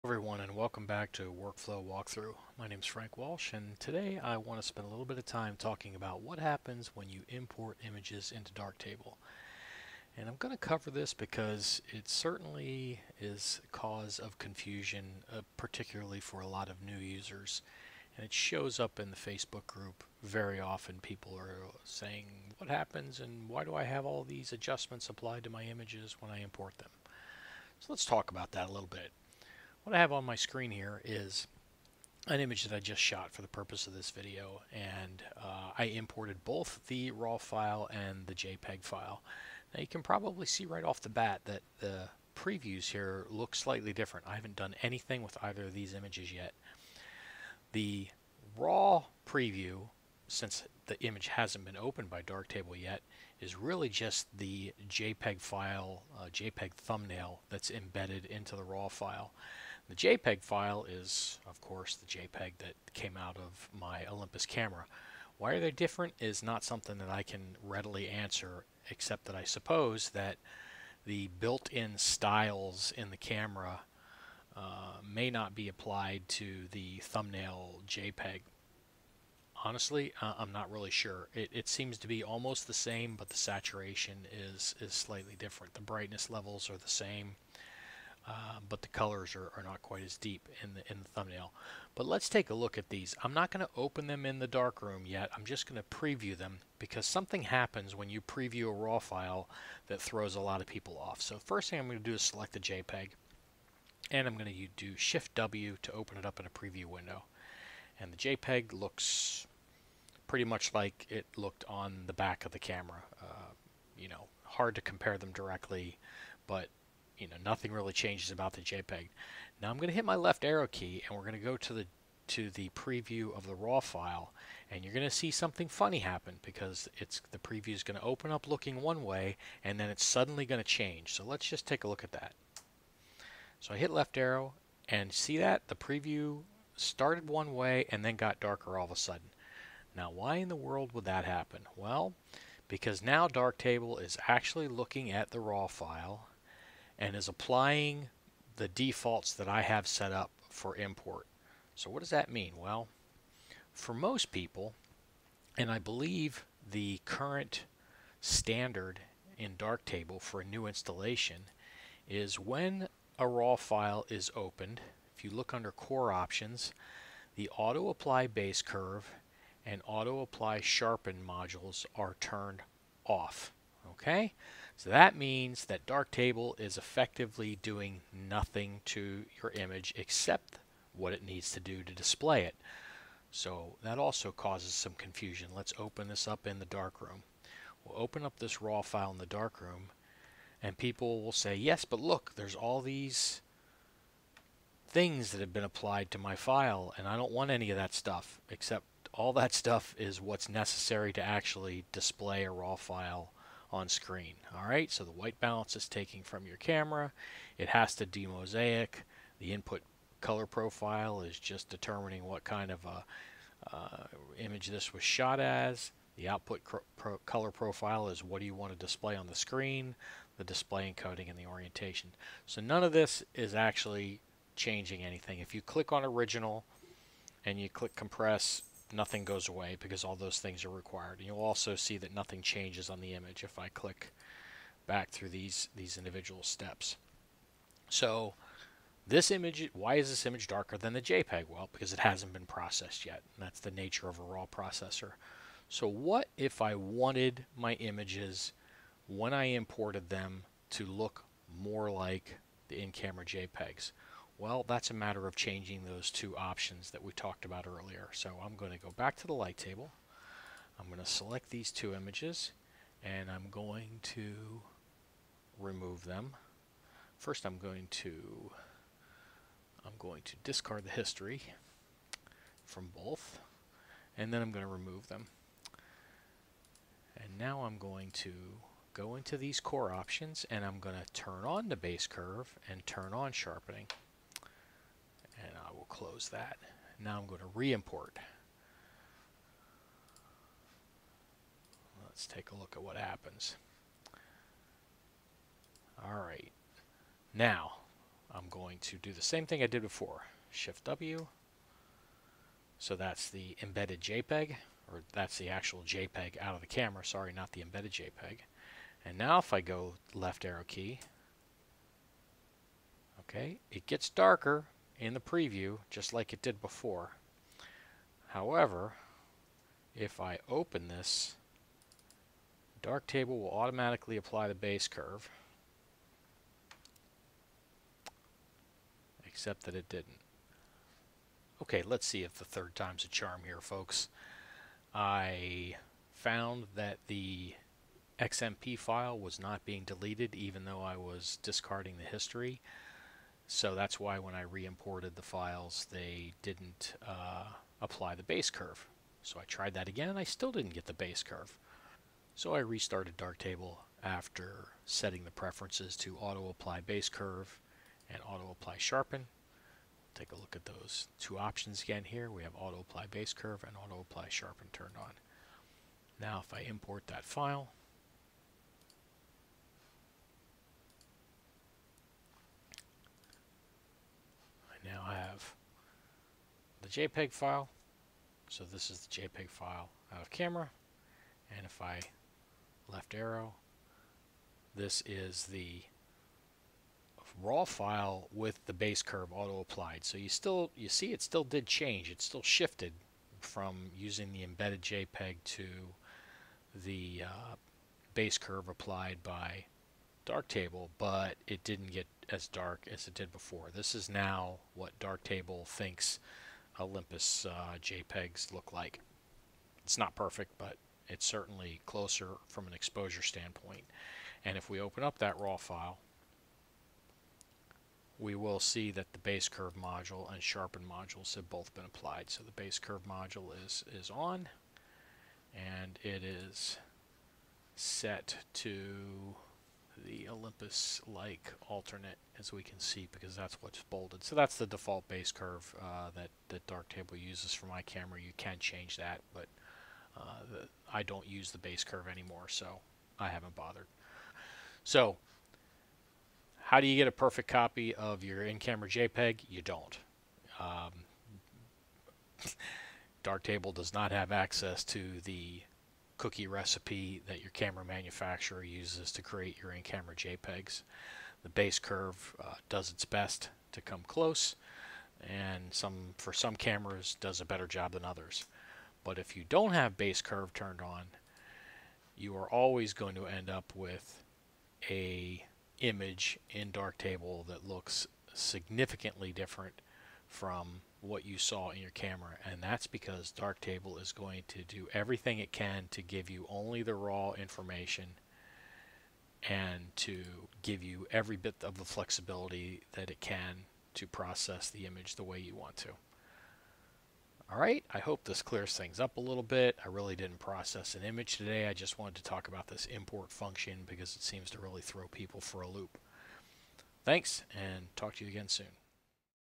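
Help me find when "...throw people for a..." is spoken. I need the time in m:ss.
8:24.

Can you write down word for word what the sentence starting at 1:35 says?
I'm just going to preview them because something happens when you preview a RAW file that throws a lot of people off.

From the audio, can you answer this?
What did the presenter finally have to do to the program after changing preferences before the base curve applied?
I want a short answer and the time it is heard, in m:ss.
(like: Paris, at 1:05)
restarted Darktable, at 5:52.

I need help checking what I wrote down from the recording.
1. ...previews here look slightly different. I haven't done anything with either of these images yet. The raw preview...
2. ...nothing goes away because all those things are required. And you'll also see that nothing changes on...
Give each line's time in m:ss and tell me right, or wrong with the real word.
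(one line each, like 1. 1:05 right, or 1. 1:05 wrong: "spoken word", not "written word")
1. 0:42 right
2. 3:48 right.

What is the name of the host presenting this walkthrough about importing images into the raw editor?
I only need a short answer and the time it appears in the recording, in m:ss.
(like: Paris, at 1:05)
Frank Walsh, at 0:02.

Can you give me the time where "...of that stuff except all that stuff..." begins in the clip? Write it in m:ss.
3:17.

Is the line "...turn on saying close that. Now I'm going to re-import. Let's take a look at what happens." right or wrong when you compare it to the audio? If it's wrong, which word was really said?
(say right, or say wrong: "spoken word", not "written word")
wrong: "sharpening", not "saying".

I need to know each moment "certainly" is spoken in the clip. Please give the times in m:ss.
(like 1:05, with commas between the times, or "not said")
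0:12, 6:51.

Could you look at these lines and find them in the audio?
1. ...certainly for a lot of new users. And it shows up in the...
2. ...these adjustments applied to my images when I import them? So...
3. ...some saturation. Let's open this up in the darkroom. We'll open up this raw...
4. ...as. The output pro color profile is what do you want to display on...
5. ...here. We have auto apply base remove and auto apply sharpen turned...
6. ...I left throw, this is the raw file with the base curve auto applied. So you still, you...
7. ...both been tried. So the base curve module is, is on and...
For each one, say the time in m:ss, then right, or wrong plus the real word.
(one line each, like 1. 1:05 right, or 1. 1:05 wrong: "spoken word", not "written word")
1. 0:15 wrong: "particularly", not "certainly"
2. 0:24 right
3. 3:04 wrong: "confusion", not "saturation"
4. 3:35 right
5. 6:02 wrong: "curve", not "remove"
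6. 6:21 wrong: "arrow", not "throw"
7. 7:01 wrong: "applied", not "tried".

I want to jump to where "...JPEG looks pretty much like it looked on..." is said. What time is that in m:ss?
1:48.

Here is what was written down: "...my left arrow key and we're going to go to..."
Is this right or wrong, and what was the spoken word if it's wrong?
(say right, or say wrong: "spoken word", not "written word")
right.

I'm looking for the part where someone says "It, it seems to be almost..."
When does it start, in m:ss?
1:21.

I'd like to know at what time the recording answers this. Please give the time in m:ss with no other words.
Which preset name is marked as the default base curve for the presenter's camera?
7:10.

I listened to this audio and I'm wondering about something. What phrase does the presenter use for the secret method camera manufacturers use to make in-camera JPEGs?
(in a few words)
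cookie recipe.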